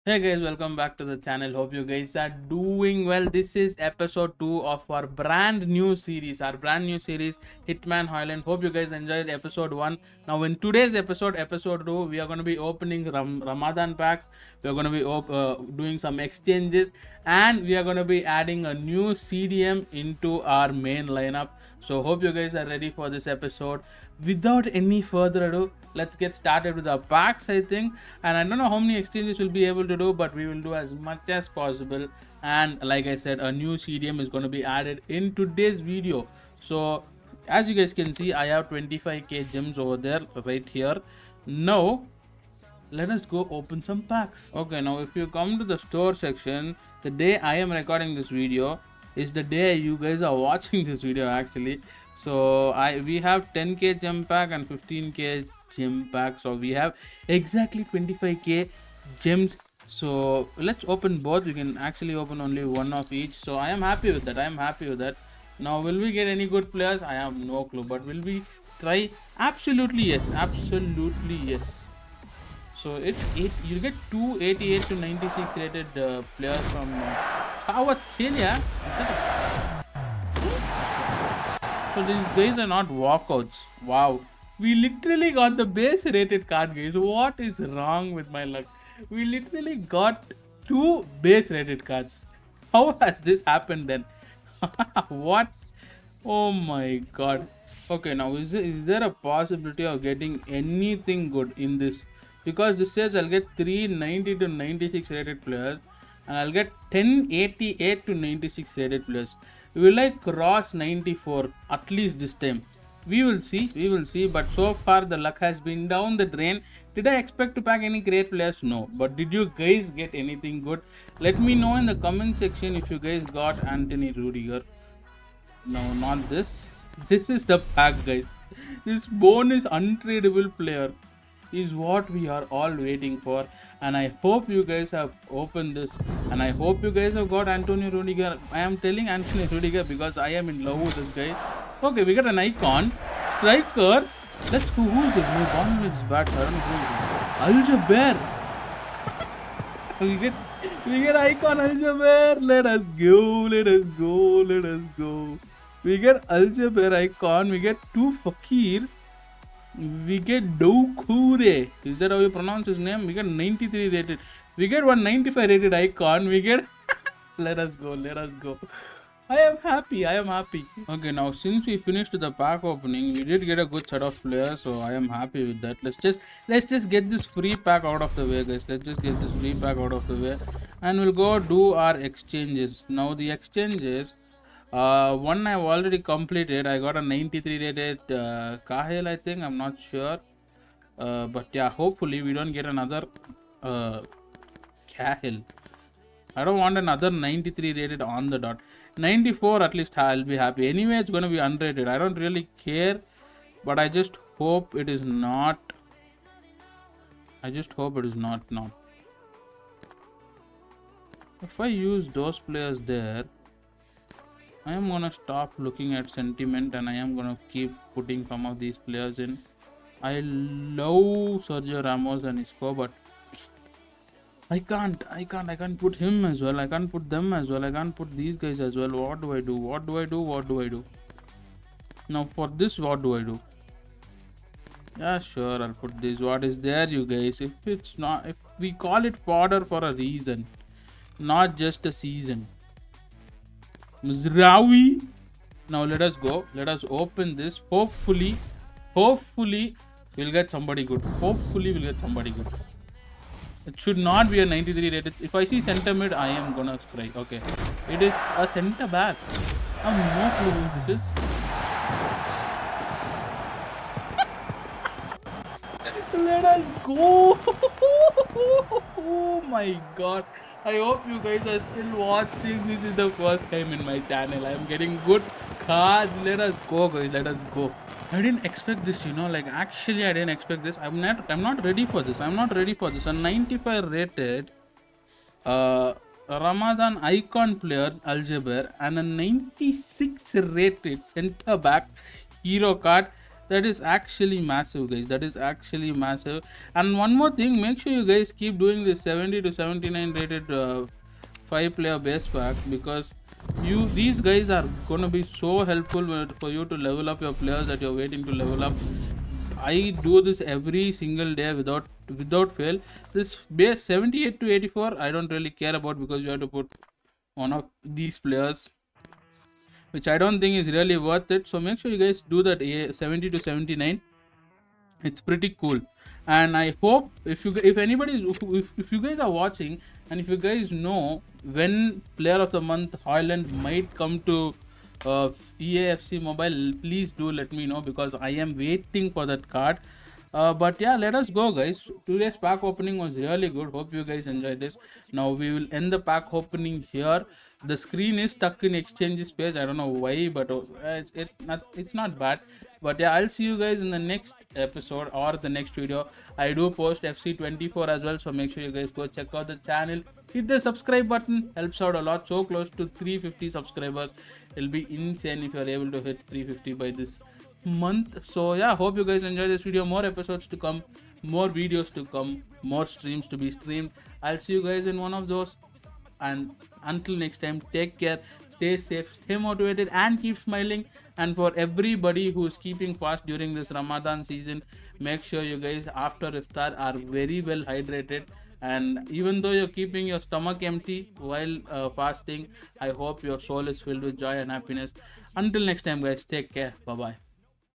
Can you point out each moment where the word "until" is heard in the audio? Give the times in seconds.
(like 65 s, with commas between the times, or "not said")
376 s, 395 s.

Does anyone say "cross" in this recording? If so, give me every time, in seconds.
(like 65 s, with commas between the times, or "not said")
110 s.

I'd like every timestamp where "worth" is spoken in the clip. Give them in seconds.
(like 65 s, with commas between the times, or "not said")
320 s.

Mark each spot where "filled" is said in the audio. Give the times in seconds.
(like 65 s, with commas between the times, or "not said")
393 s.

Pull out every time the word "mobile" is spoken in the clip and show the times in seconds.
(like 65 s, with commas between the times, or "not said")
336 s.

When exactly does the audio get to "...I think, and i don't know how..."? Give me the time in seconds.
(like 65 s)
27 s.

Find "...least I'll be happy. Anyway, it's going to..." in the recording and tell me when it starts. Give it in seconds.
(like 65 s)
199 s.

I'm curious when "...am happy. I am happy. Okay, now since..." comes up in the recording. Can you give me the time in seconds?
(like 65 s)
169 s.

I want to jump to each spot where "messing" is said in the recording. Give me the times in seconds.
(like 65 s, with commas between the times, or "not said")
not said.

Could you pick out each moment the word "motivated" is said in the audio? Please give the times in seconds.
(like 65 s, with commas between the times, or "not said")
379 s.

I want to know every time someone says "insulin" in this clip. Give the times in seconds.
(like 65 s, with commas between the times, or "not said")
not said.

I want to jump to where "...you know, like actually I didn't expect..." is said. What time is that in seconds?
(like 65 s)
279 s.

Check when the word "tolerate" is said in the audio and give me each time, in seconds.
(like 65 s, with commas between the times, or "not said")
not said.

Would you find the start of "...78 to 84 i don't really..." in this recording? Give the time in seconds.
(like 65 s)
313 s.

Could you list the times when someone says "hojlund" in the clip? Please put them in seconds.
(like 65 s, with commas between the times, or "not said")
8 s, 333 s.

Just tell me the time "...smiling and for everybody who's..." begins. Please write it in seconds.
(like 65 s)
380 s.